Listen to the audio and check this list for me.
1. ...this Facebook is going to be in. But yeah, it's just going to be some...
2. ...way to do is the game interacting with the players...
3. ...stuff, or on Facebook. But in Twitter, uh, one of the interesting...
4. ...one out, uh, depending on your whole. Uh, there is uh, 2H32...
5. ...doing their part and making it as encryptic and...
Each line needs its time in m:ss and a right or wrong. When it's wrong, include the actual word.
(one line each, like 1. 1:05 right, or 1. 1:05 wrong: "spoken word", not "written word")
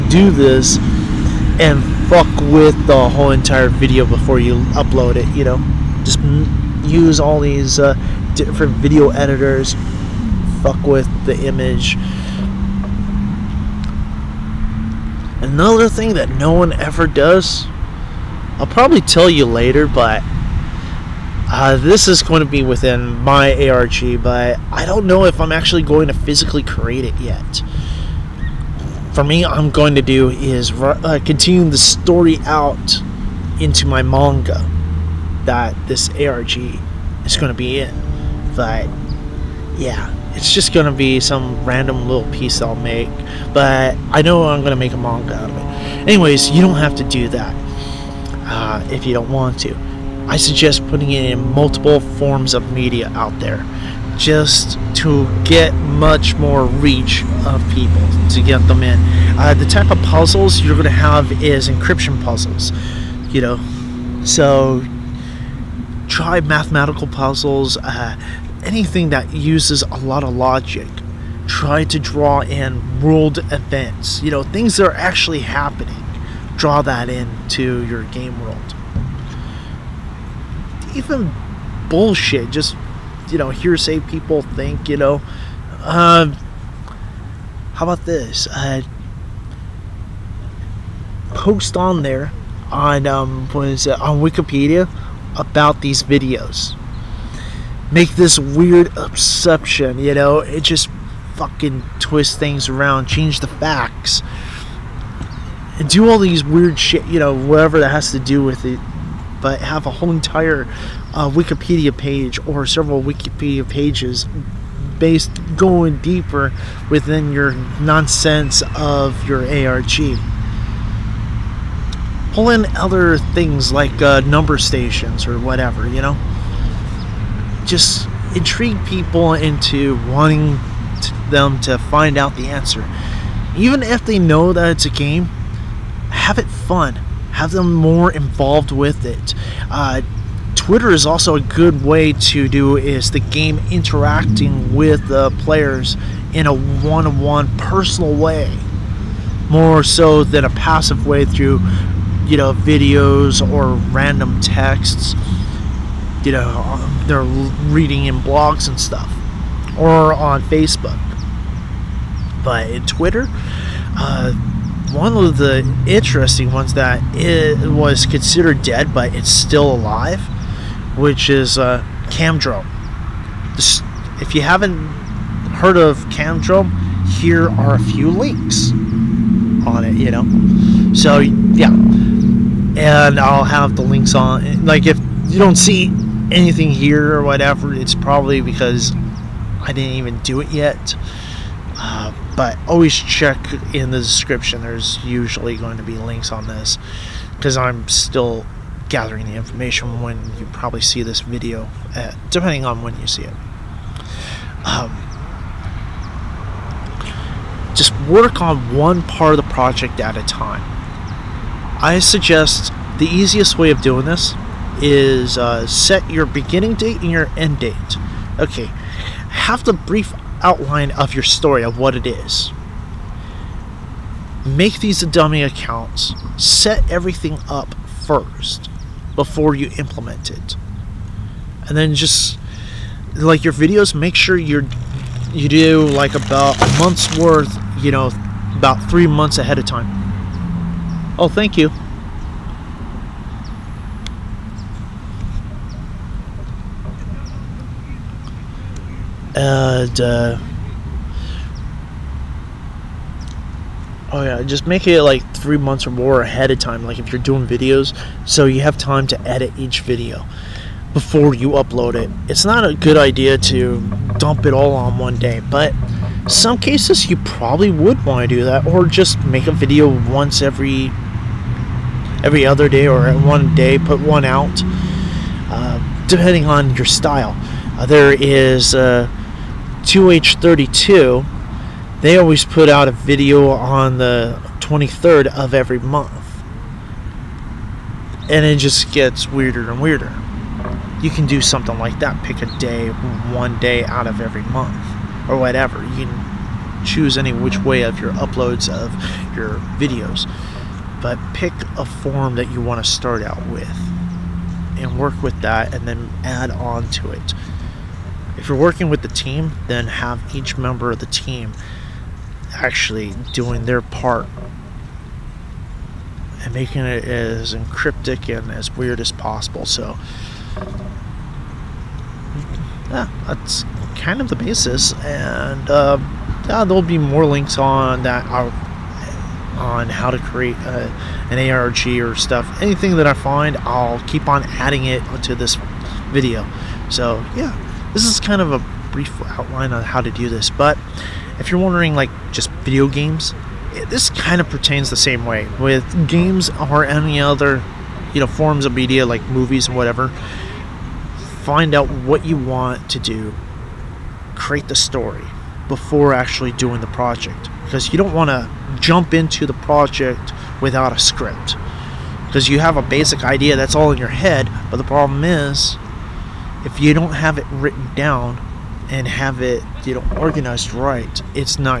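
1. 0:35 wrong: "ARG", not "Facebook"
2. 2:21 right
3. 2:38 right
4. 4:34 wrong: "style", not "whole"
5. 5:13 right.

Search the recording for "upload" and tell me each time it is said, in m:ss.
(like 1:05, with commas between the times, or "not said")
0:04, 4:21, 4:58.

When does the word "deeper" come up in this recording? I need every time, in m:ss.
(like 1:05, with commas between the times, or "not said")
1:55.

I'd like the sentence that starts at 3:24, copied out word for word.
Um, just work on one part of the project at a time.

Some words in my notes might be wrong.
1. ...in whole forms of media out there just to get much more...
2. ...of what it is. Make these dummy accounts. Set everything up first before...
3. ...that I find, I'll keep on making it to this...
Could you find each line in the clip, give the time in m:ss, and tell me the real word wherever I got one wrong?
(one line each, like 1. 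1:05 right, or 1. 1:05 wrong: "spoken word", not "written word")
1. 0:51 wrong: "multiple", not "whole"
2. 3:41 right
3. 5:32 wrong: "adding", not "making".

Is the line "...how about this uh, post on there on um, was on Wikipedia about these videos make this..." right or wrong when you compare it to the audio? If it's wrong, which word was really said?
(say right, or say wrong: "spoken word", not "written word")
right.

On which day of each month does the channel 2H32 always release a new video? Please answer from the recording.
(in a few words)
23rd.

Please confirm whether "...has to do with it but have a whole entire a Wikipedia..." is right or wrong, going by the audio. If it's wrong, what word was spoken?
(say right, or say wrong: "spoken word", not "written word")
right.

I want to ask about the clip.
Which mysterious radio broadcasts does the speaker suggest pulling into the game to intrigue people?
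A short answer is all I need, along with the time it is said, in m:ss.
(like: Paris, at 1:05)
number stations, at 2:04.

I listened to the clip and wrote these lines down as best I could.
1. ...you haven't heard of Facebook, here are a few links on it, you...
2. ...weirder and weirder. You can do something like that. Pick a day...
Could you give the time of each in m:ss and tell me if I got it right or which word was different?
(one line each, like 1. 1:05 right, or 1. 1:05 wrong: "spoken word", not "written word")
1. 2:54 wrong: "Camdrome", not "Facebook"
2. 4:49 right.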